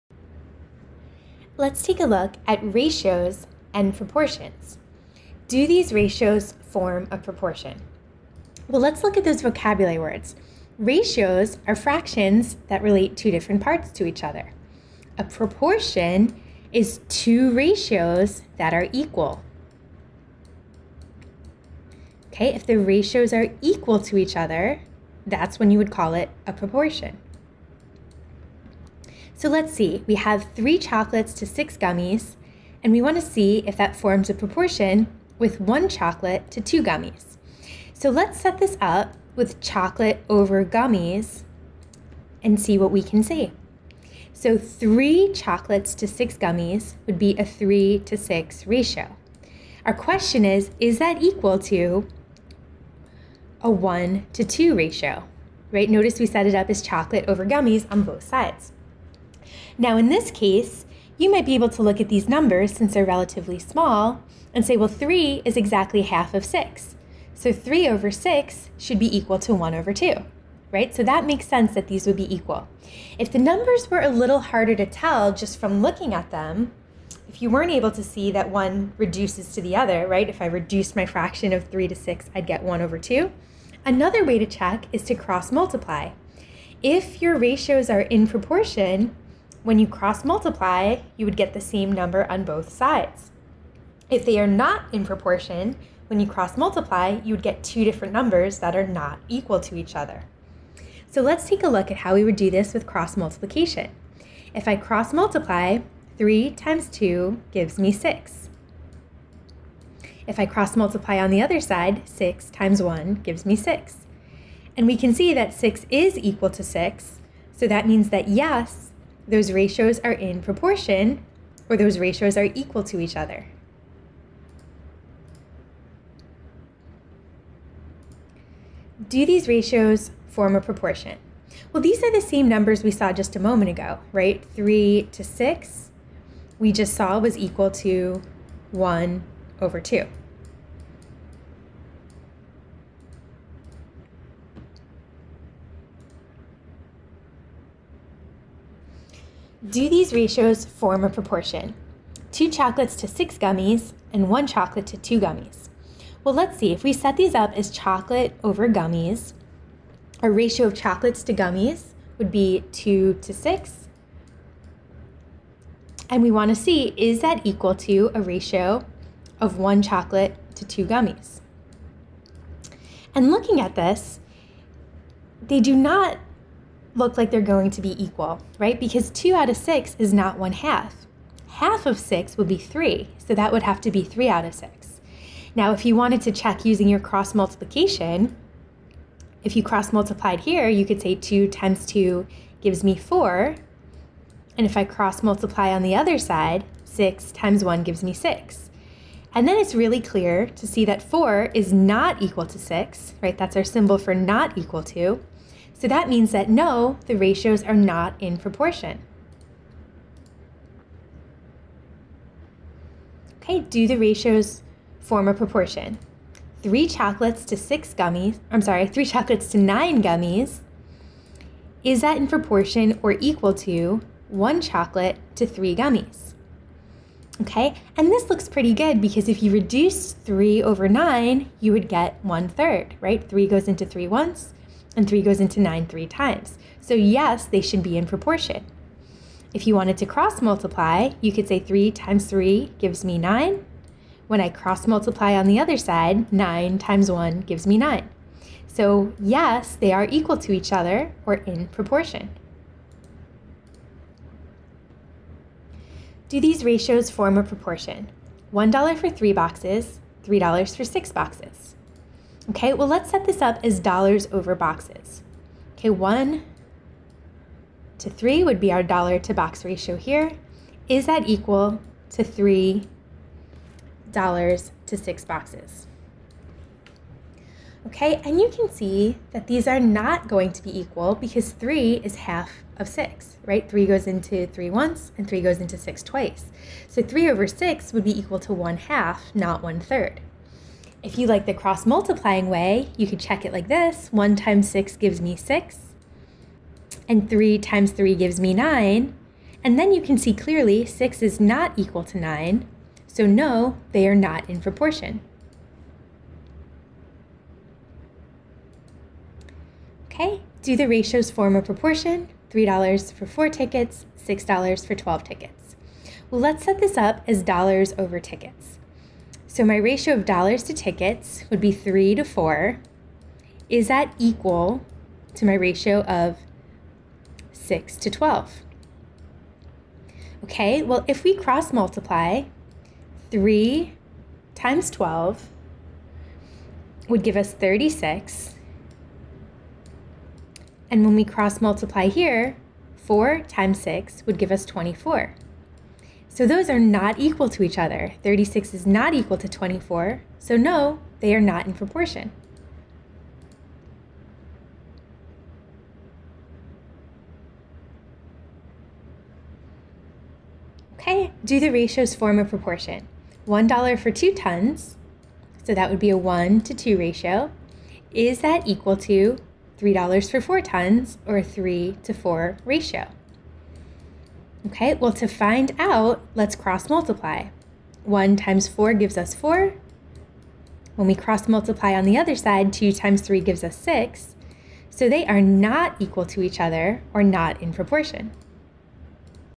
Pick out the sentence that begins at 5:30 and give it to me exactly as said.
Okay, well, if we cross multiply, 3 times 12 would give us 36.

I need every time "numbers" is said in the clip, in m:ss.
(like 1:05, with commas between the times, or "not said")
1:02, 1:13, 1:31, 1:38, 2:12.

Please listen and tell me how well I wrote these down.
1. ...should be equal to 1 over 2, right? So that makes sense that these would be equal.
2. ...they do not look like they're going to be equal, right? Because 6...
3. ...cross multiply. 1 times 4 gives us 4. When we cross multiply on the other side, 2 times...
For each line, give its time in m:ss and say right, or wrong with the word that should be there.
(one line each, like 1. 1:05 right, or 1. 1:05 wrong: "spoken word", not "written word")
1. 1:08 right
2. 2:55 wrong: "2", not "6"
3. 6:16 right.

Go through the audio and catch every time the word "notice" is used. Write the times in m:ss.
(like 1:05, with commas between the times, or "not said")
0:55.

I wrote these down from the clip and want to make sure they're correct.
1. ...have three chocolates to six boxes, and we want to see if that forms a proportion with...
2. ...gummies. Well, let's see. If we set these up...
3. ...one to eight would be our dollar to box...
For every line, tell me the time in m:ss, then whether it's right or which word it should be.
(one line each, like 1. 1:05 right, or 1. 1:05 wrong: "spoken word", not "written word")
1. 0:30 wrong: "gummies", not "boxes"
2. 2:35 right
3. 4:25 wrong: "three", not "eight".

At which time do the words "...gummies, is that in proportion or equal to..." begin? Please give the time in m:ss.
3:40.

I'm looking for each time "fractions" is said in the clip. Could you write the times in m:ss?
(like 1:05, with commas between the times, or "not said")
0:11, 1:21.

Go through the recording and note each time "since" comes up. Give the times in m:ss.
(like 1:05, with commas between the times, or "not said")
1:02.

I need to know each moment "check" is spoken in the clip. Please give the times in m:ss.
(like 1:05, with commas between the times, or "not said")
1:24, 3:06, 4:53.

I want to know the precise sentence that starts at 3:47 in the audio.
Okay, and this looks pretty good because if you reduce three over nine, you would get one third, right?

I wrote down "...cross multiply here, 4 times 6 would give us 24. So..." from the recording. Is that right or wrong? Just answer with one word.
right.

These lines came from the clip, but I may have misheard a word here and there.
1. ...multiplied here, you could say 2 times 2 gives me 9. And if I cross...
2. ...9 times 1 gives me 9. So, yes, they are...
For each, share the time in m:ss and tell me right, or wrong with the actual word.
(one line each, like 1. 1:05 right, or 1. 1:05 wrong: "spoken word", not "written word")
1. 3:09 wrong: "4", not "9"
2. 4:06 right.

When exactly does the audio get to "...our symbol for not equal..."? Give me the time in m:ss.
3:23.